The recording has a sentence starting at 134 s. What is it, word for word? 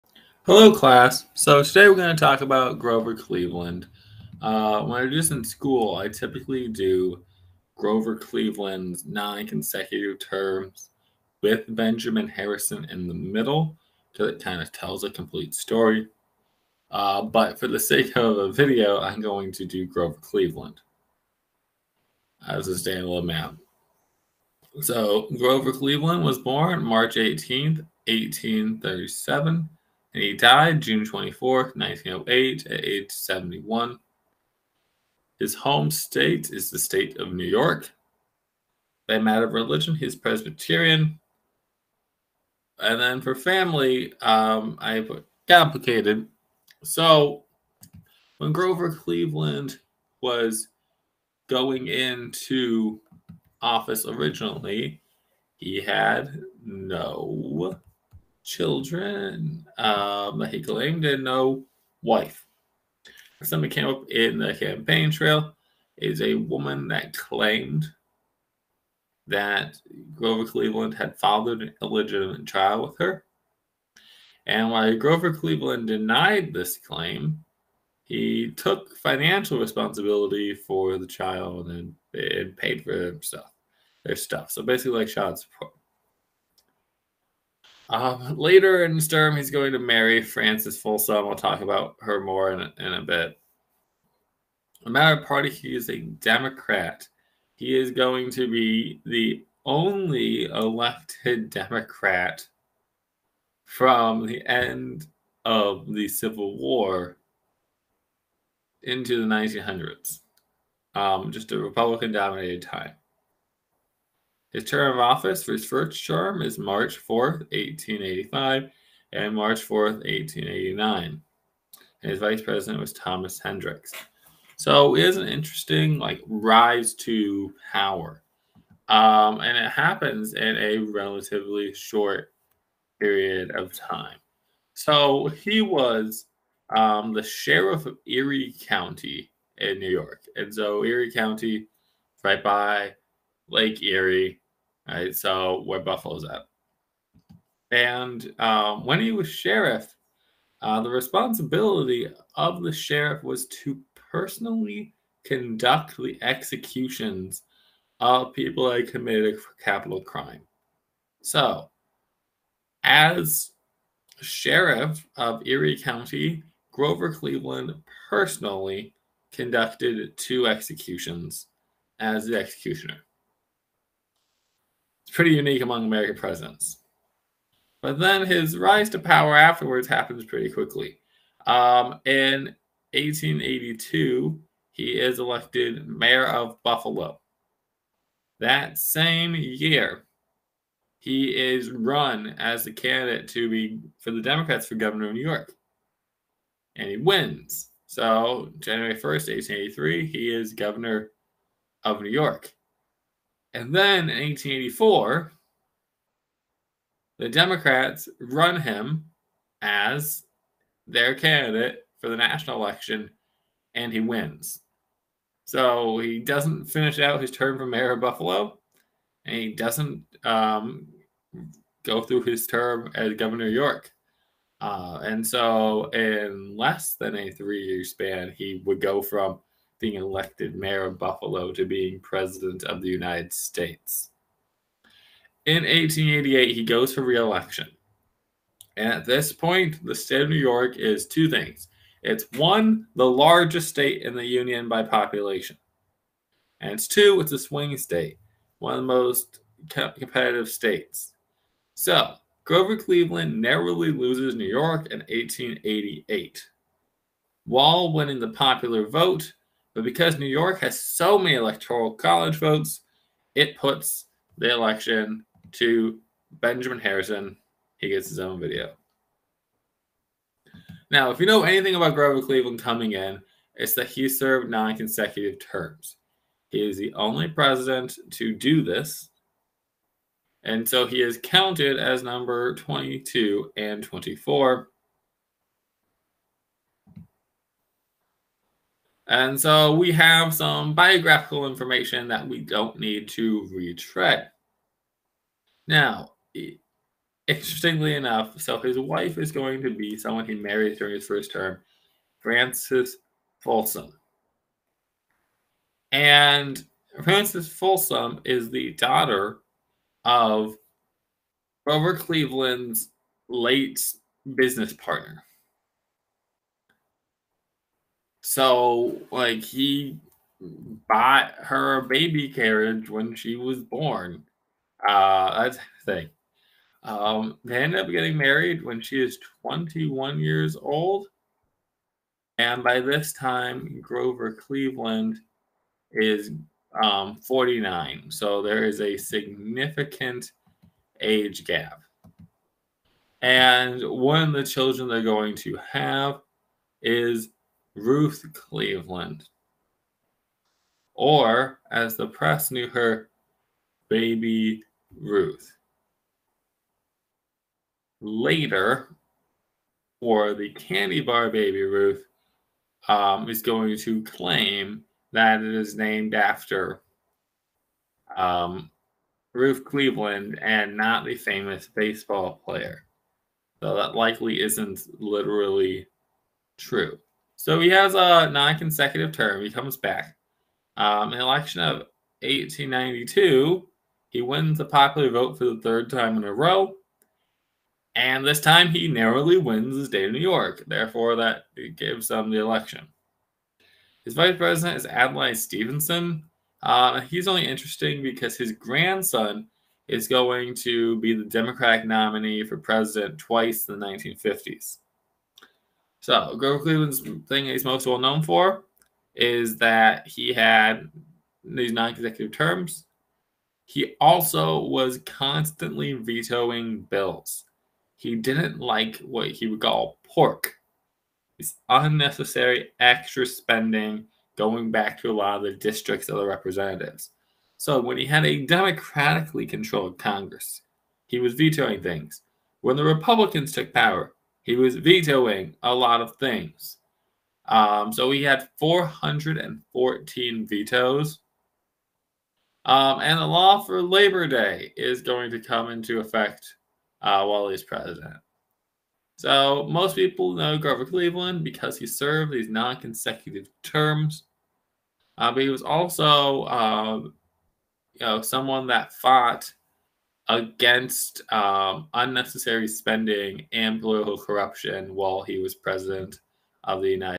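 So he was um, the sheriff of Erie County in New York.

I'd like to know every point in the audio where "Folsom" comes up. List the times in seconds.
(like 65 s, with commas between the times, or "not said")
90 s, 303 s, 307 s.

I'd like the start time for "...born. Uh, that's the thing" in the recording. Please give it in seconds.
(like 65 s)
323 s.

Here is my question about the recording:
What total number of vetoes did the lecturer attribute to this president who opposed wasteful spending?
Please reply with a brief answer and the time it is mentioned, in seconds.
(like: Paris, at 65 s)
414, at 438 s.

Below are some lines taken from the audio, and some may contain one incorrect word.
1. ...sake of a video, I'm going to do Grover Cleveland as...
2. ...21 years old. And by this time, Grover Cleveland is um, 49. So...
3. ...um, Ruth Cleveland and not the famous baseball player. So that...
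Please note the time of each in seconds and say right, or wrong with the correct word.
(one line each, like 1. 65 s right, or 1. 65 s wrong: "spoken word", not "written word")
1. 17 s right
2. 329 s right
3. 368 s right.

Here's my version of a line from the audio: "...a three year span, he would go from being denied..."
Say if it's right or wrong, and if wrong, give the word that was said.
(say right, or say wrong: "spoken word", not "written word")
wrong: "elected", not "denied".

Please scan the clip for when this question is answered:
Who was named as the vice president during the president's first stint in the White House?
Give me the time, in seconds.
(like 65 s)
122 s.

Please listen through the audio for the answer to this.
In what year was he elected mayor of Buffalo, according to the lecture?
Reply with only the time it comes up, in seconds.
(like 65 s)
182 s.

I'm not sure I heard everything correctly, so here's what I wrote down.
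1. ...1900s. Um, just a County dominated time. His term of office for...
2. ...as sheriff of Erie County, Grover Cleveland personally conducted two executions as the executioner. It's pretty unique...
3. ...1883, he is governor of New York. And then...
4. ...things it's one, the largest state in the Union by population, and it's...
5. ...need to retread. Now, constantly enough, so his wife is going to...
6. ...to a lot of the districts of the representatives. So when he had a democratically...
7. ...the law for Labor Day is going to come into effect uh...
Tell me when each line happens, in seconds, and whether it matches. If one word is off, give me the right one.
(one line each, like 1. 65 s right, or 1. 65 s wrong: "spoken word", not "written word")
1. 109 s wrong: "Republican", not "County"
2. 162 s right
3. 199 s right
4. 241 s right
5. 292 s wrong: "interestingly", not "constantly"
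6. 425 s right
7. 443 s right.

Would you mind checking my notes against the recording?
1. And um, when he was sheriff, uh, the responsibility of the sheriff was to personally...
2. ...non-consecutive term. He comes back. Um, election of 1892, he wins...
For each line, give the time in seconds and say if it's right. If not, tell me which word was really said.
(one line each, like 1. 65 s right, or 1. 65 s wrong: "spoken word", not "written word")
1. 147 s right
2. 378 s right.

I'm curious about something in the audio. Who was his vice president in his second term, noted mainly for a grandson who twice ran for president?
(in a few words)
Adlai Stevenson.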